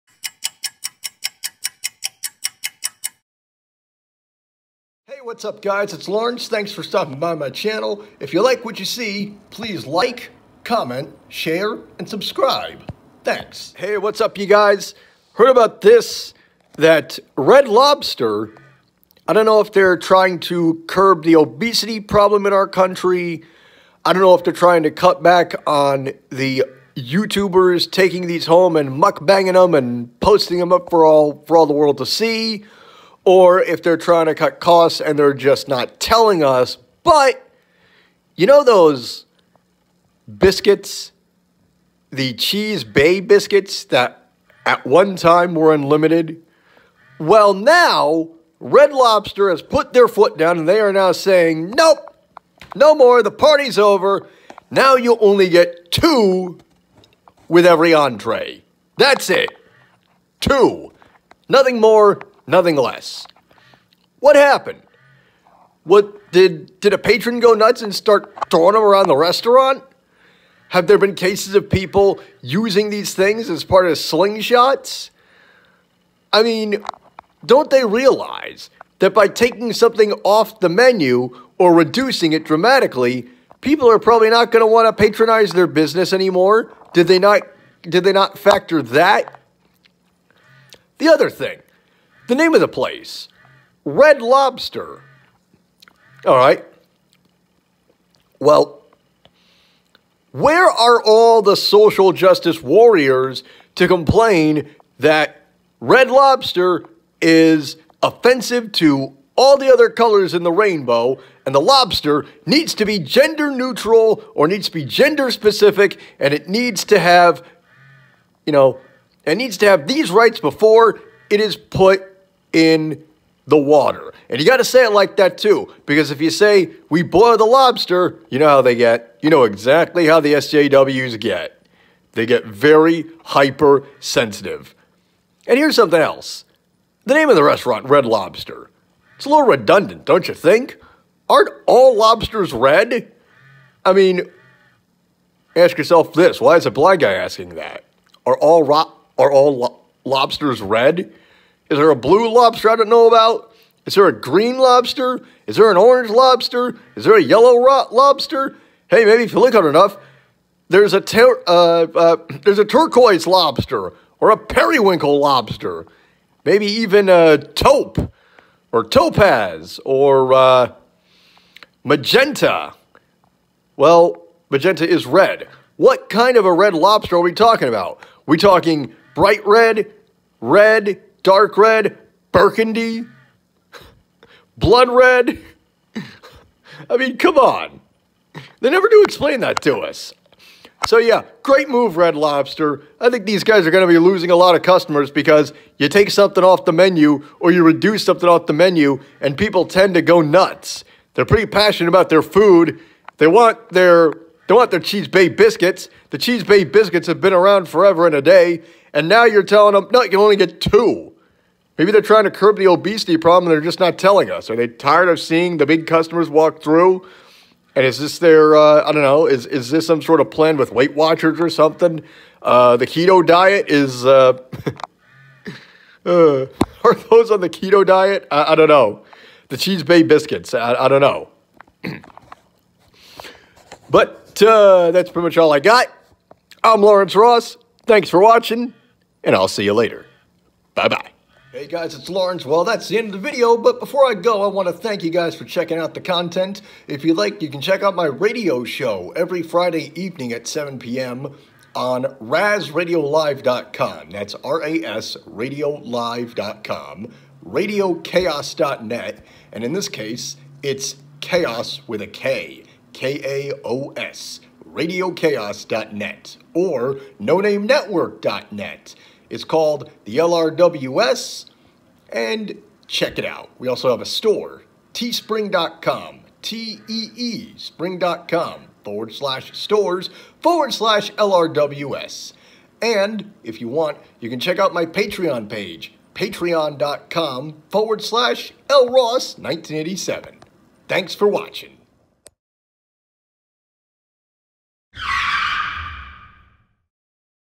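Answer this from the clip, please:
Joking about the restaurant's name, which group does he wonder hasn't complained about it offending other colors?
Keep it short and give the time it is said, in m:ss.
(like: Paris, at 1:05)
social justice warriors, at 1:41.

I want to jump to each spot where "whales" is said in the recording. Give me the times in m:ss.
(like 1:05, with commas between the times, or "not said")
not said.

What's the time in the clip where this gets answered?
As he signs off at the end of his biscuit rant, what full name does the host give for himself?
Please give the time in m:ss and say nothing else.
3:56.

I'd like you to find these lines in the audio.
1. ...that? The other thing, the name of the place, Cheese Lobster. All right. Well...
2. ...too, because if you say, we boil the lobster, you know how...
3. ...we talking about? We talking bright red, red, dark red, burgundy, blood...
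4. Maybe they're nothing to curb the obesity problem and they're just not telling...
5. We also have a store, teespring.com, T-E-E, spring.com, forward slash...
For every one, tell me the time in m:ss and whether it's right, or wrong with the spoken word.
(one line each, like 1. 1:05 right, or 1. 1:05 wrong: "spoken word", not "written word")
1. 1:28 wrong: "Red", not "Cheese"
2. 2:05 right
3. 2:57 right
4. 3:31 wrong: "trying", not "nothing"
5. 4:33 right.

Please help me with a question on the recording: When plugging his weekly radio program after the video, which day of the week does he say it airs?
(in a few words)
Friday.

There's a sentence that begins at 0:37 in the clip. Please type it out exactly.
But you know those biscuits, the Cheese Bay biscuits that at one time were unlimited?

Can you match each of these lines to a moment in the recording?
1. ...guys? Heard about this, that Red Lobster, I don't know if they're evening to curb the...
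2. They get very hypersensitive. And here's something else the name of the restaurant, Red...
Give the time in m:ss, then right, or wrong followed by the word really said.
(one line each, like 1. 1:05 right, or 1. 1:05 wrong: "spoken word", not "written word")
1. 0:14 wrong: "trying", not "evening"
2. 2:12 right.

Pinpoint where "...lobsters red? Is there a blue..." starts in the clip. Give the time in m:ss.
2:30.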